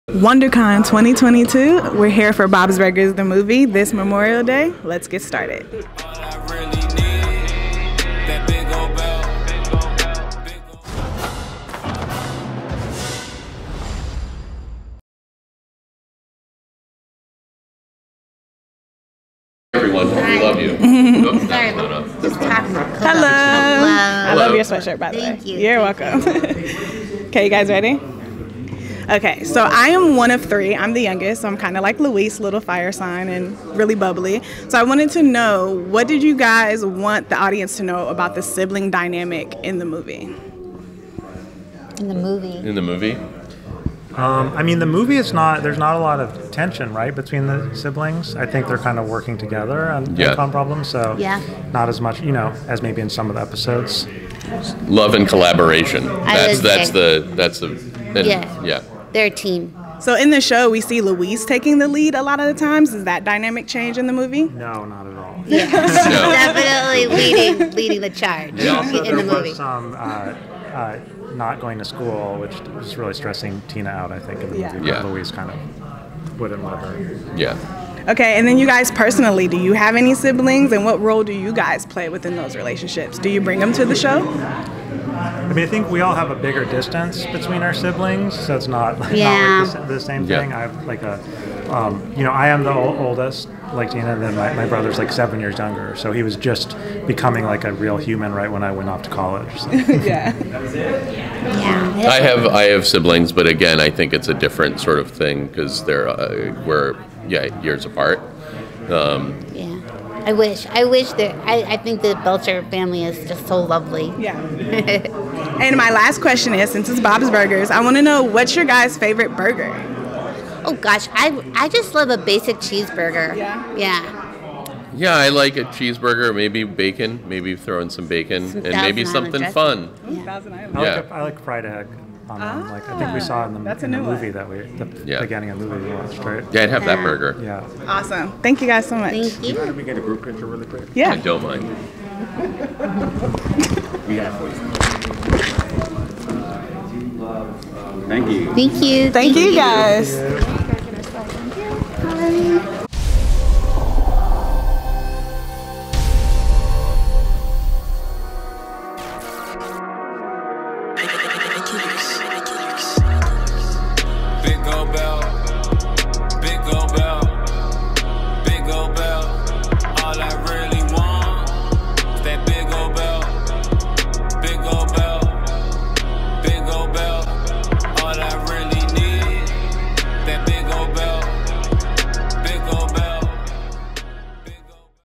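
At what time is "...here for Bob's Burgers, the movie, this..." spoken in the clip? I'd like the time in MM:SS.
00:02.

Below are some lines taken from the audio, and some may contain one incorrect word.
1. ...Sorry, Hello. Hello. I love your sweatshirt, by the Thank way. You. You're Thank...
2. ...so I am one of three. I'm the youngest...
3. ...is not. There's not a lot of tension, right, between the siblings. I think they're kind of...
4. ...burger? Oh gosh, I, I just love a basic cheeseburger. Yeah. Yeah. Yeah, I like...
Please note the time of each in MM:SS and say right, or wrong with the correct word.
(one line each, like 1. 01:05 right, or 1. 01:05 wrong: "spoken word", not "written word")
1. 00:21 right
2. 00:29 right
3. 00:45 right
4. 01:59 right.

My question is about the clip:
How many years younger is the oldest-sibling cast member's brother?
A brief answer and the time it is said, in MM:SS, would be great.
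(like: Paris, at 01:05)
7, at 01:35.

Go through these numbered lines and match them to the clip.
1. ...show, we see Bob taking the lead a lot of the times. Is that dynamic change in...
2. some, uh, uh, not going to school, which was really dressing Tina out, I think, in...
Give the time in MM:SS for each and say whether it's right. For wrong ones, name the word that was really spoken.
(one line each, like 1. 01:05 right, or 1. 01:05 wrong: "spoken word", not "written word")
1. 01:00 wrong: "Louise", not "Bob"
2. 01:09 wrong: "stressing", not "dressing".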